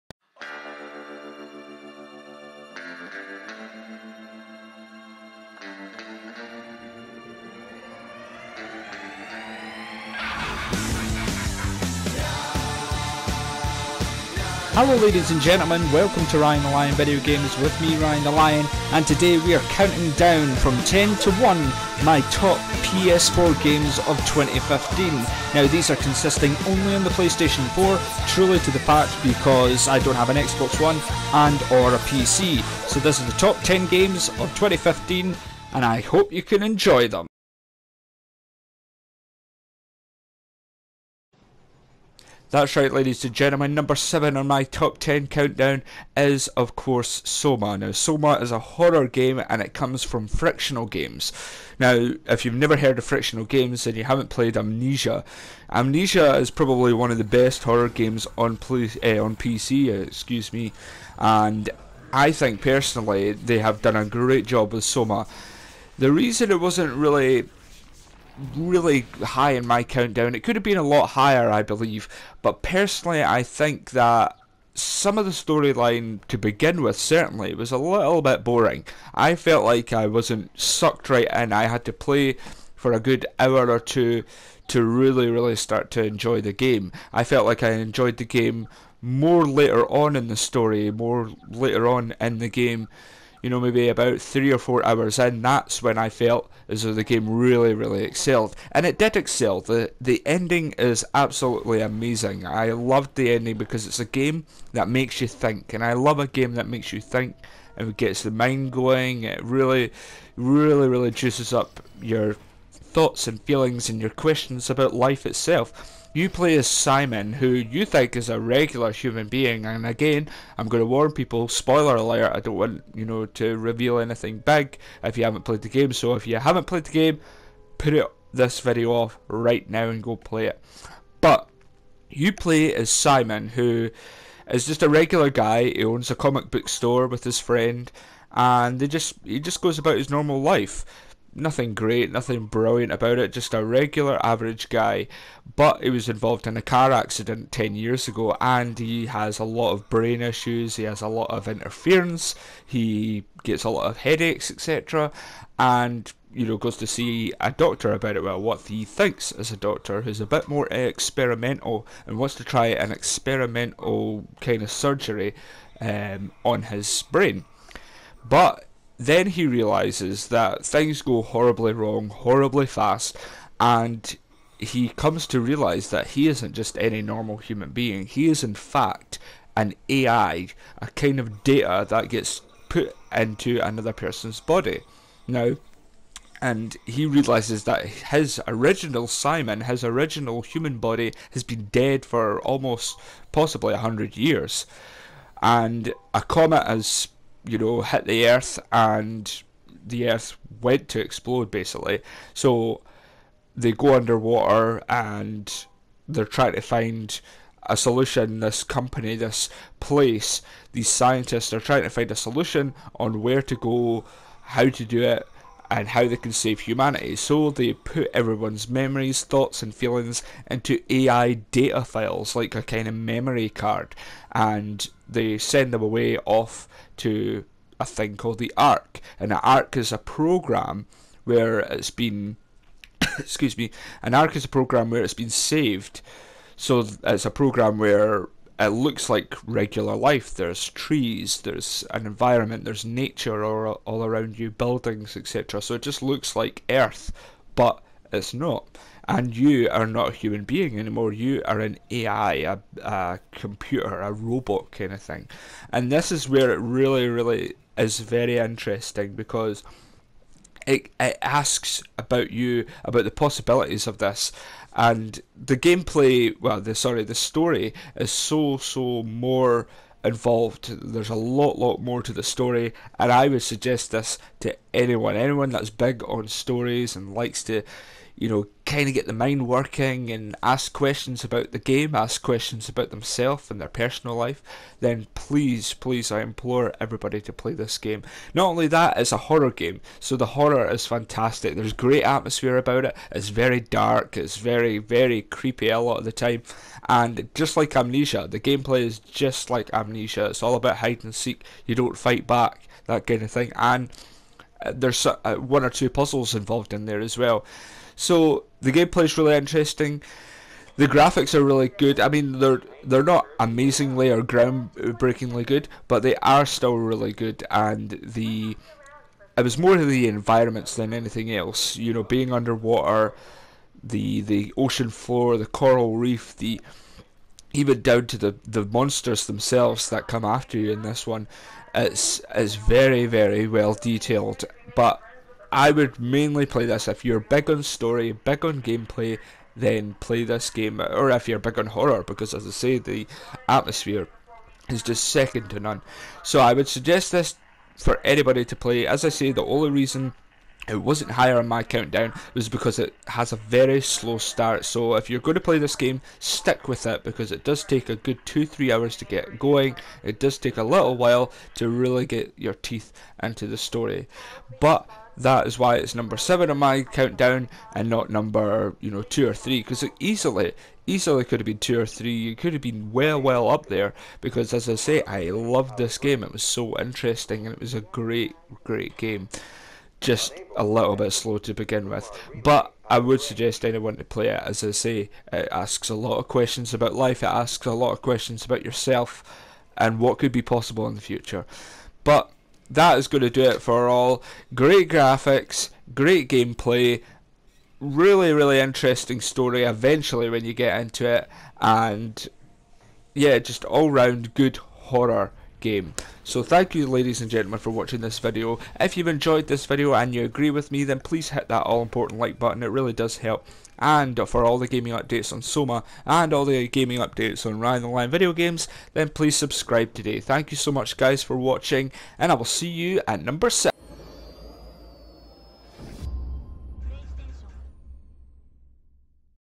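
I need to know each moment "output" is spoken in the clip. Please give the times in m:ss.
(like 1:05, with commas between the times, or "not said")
not said.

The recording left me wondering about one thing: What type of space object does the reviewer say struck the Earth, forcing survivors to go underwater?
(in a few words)
comet.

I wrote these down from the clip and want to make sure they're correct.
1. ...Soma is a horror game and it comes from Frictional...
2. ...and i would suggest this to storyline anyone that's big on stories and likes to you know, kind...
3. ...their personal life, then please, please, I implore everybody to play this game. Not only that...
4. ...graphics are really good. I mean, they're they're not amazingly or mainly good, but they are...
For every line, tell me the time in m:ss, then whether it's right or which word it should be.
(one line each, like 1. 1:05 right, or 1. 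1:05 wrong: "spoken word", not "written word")
1. 0:47 right
2. 4:32 wrong: "anyone", not "storyline"
3. 4:43 right
4. 5:10 wrong: "groundbreakingly", not "mainly".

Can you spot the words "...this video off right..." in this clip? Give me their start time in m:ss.
2:08.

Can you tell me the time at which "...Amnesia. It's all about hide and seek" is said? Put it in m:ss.
4:59.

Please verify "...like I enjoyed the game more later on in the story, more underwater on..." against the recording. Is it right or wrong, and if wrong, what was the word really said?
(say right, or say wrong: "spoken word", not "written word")
wrong: "later", not "underwater".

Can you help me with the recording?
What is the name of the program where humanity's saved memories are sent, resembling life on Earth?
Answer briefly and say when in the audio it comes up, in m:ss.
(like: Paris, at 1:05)
the ARK, at 3:48.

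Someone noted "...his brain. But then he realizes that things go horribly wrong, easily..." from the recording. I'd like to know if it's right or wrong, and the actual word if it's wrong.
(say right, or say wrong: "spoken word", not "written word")
wrong: "horribly", not "easily".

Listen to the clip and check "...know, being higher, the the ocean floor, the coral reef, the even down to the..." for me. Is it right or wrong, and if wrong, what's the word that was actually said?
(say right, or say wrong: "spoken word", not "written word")
wrong: "underwater", not "higher".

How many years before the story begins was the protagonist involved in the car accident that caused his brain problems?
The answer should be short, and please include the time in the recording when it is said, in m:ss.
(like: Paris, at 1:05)
10, at 2:27.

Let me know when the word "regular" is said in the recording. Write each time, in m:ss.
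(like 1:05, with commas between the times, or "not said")
1:58, 2:14, 2:23, 3:59.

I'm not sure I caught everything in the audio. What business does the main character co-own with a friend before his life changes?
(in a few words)
comic book store.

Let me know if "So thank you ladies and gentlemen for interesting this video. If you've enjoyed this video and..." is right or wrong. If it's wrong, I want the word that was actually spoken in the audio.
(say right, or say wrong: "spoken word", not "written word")
wrong: "watching", not "interesting".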